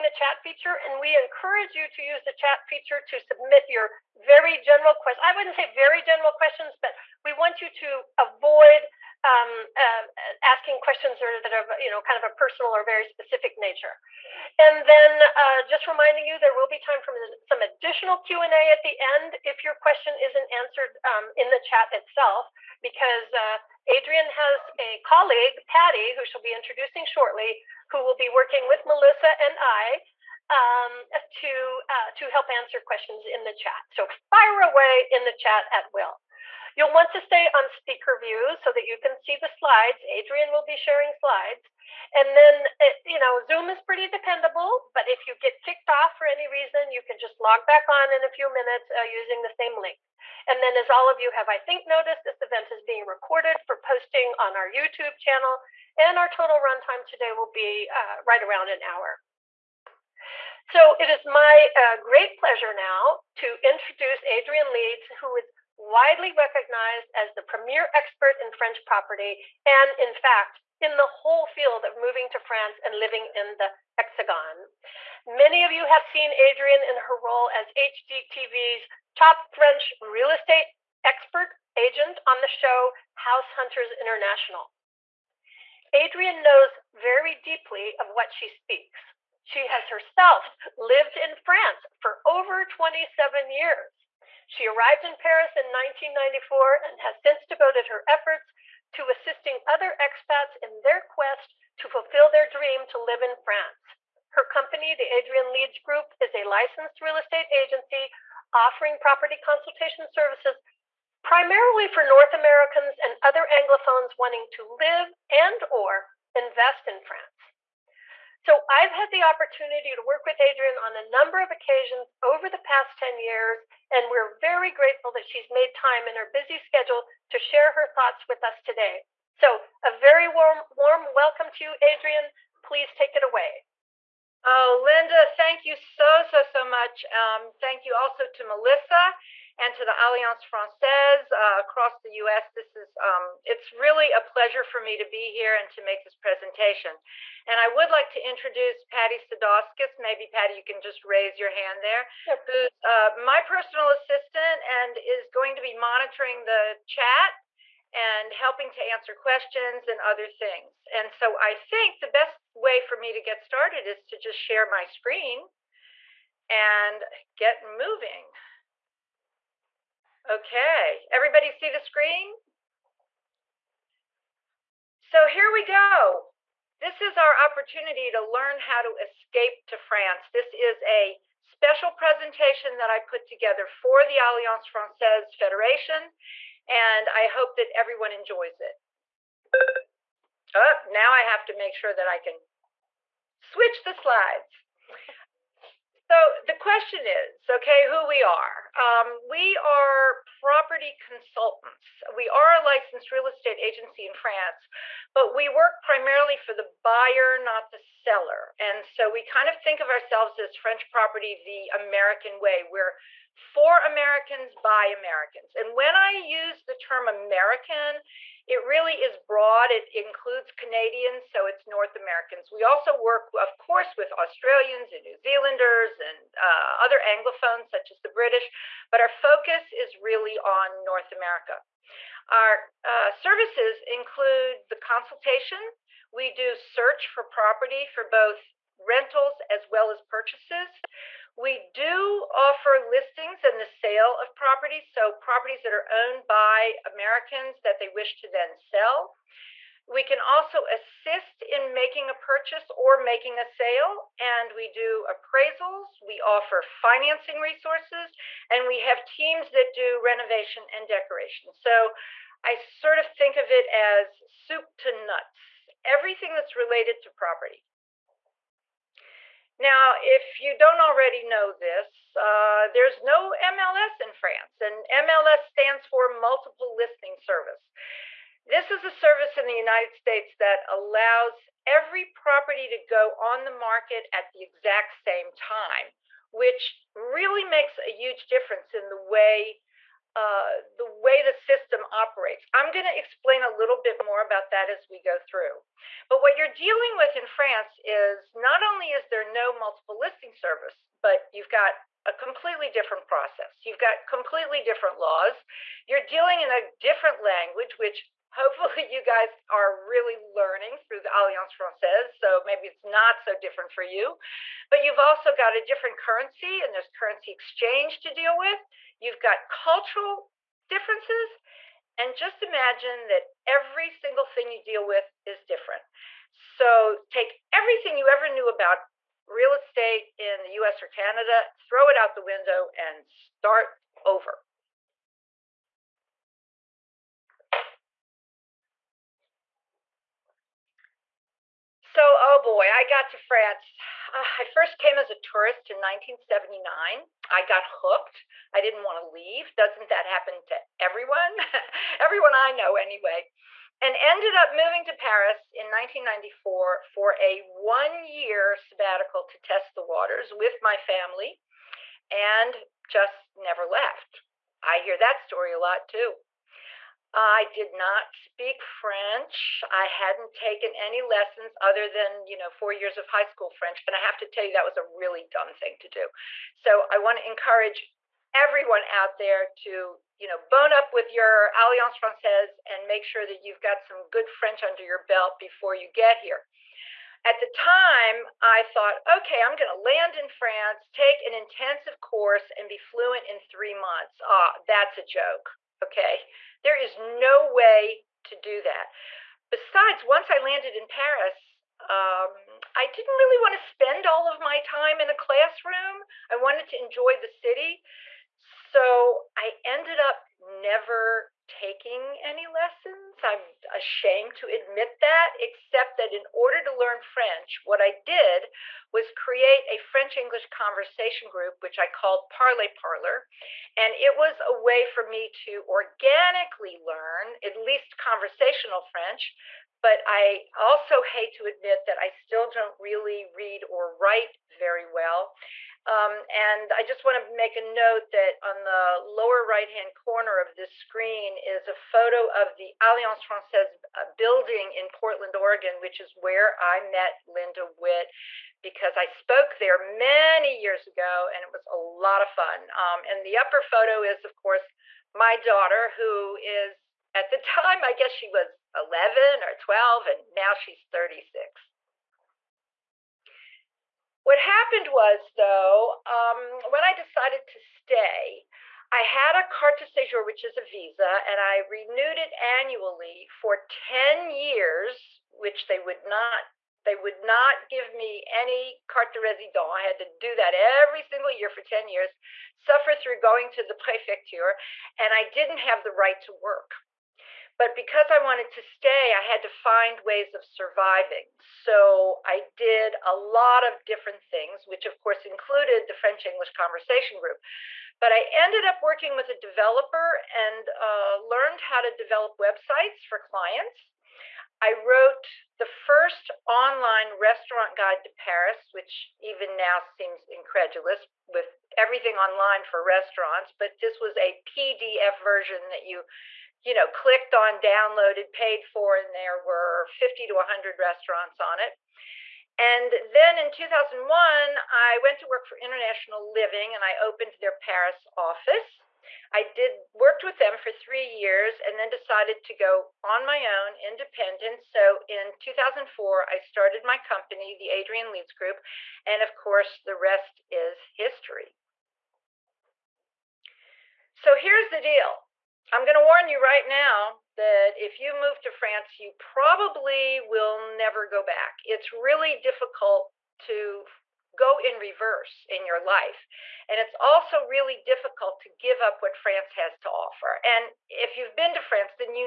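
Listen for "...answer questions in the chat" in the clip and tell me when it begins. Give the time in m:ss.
0:32.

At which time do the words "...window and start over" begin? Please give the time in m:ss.
5:32.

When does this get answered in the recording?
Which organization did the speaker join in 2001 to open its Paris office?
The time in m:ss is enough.
8:45.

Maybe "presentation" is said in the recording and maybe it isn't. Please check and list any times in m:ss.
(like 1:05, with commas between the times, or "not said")
2:26, 3:01.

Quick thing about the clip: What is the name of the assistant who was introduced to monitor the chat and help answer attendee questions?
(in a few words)
Patty Sadowskis.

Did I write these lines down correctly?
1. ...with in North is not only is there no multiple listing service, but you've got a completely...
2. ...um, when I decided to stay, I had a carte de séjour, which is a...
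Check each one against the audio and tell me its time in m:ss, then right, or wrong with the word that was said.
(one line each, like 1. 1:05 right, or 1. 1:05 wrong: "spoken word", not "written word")
1. 4:56 wrong: "France", not "North"
2. 7:46 right.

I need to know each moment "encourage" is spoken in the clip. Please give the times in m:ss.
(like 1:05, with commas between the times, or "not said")
0:01, 6:17.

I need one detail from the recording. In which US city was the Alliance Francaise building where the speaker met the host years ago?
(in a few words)
Portland, Oregon.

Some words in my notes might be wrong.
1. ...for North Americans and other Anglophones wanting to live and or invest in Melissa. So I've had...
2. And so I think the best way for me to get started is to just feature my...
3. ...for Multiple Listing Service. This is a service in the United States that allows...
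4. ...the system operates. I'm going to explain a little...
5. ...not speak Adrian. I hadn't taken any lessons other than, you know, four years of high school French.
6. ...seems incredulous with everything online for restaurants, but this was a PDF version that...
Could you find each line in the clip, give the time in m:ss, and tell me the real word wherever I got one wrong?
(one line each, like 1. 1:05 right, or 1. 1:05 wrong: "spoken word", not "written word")
1. 1:51 wrong: "France", not "Melissa"
2. 2:40 wrong: "share", not "feature"
3. 4:35 right
4. 4:51 right
5. 6:07 wrong: "French", not "Adrian"
6. 8:29 right.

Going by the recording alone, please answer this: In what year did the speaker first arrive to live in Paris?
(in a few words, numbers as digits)
1994.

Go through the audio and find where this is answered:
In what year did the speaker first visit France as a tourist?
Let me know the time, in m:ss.
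5:45.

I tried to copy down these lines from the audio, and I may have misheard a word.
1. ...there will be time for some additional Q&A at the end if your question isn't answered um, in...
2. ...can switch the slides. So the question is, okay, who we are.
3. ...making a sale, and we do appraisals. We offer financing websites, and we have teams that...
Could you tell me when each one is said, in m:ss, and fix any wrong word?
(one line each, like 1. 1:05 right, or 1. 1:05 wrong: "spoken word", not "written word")
1. 0:16 right
2. 3:12 right
3. 4:12 wrong: "resources", not "websites".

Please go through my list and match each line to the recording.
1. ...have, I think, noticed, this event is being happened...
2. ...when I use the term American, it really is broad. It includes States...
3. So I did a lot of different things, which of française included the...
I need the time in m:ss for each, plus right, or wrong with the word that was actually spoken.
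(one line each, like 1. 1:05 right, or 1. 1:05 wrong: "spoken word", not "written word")
1. 0:51 wrong: "recorded", not "happened"
2. 3:35 wrong: "Canadians", not "States"
3. 8:11 wrong: "course", not "française".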